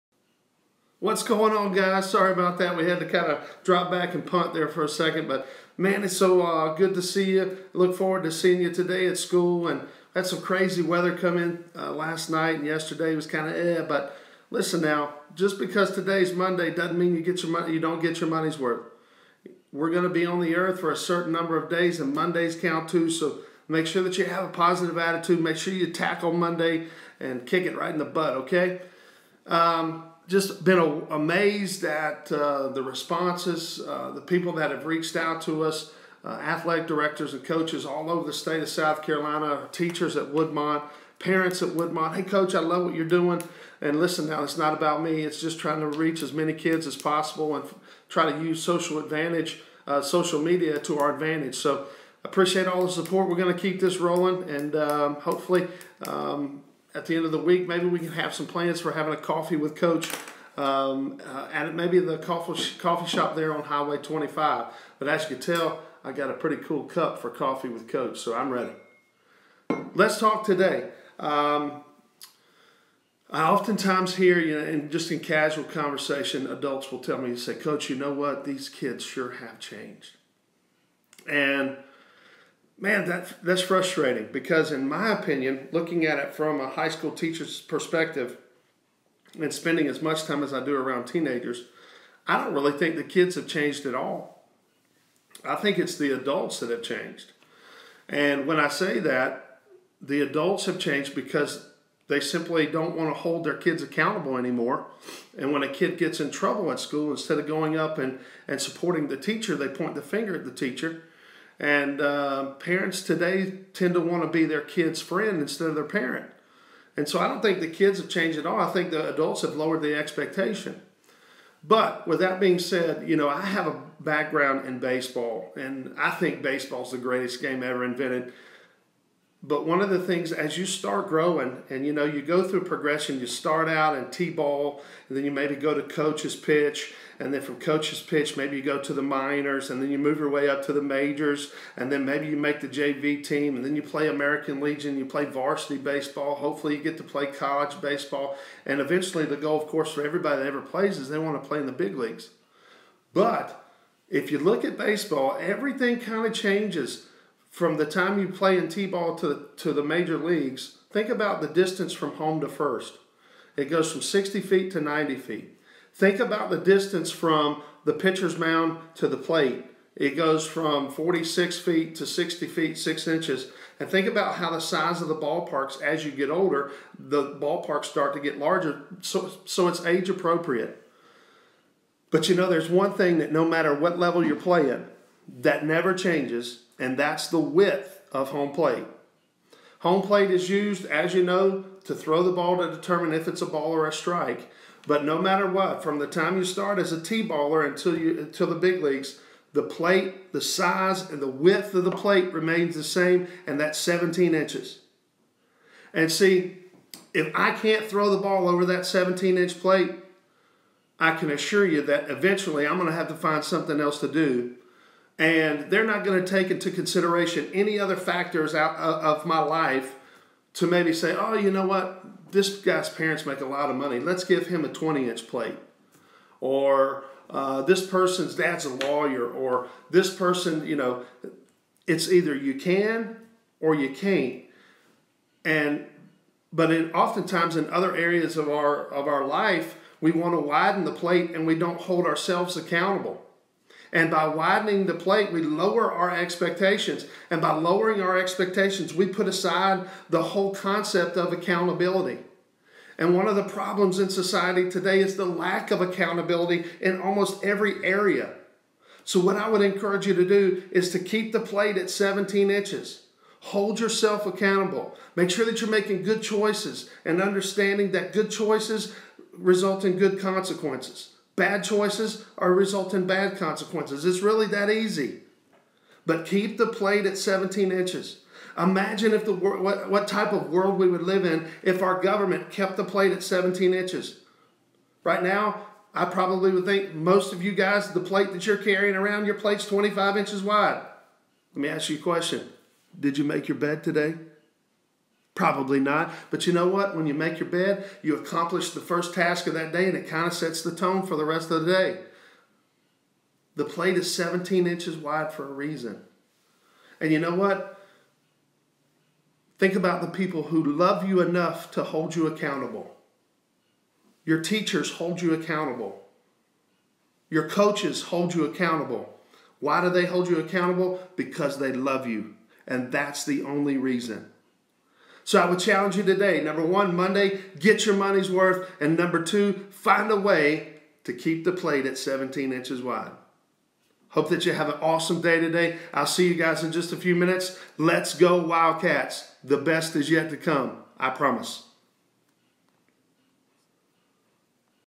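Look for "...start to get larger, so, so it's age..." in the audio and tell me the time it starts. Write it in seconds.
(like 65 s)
177 s.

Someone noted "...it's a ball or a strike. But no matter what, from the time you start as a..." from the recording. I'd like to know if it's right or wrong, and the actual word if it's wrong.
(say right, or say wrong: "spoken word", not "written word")
right.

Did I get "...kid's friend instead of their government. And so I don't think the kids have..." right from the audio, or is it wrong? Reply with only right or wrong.
wrong.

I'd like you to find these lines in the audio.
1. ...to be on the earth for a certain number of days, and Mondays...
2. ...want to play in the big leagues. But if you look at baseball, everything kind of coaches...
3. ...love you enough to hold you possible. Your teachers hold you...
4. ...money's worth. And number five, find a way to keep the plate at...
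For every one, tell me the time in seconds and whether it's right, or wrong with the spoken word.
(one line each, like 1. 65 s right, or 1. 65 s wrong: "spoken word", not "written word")
1. 20 s right
2. 151 s wrong: "changes", not "coaches"
3. 310 s wrong: "accountable", not "possible"
4. 327 s wrong: "two", not "five".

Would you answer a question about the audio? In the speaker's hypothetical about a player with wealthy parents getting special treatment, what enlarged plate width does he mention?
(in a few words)
20 inches.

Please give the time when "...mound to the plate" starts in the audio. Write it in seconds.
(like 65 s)
168 s.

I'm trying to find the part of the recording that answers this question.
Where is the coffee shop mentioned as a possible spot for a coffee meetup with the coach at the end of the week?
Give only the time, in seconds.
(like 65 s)
63 s.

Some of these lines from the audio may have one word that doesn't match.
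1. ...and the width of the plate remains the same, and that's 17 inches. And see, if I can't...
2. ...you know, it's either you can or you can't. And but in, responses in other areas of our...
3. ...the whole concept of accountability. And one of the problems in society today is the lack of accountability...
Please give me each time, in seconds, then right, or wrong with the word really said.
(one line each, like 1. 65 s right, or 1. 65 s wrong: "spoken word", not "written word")
1. 201 s right
2. 230 s wrong: "oftentimes", not "responses"
3. 250 s right.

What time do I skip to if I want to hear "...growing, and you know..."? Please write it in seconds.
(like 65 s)
131 s.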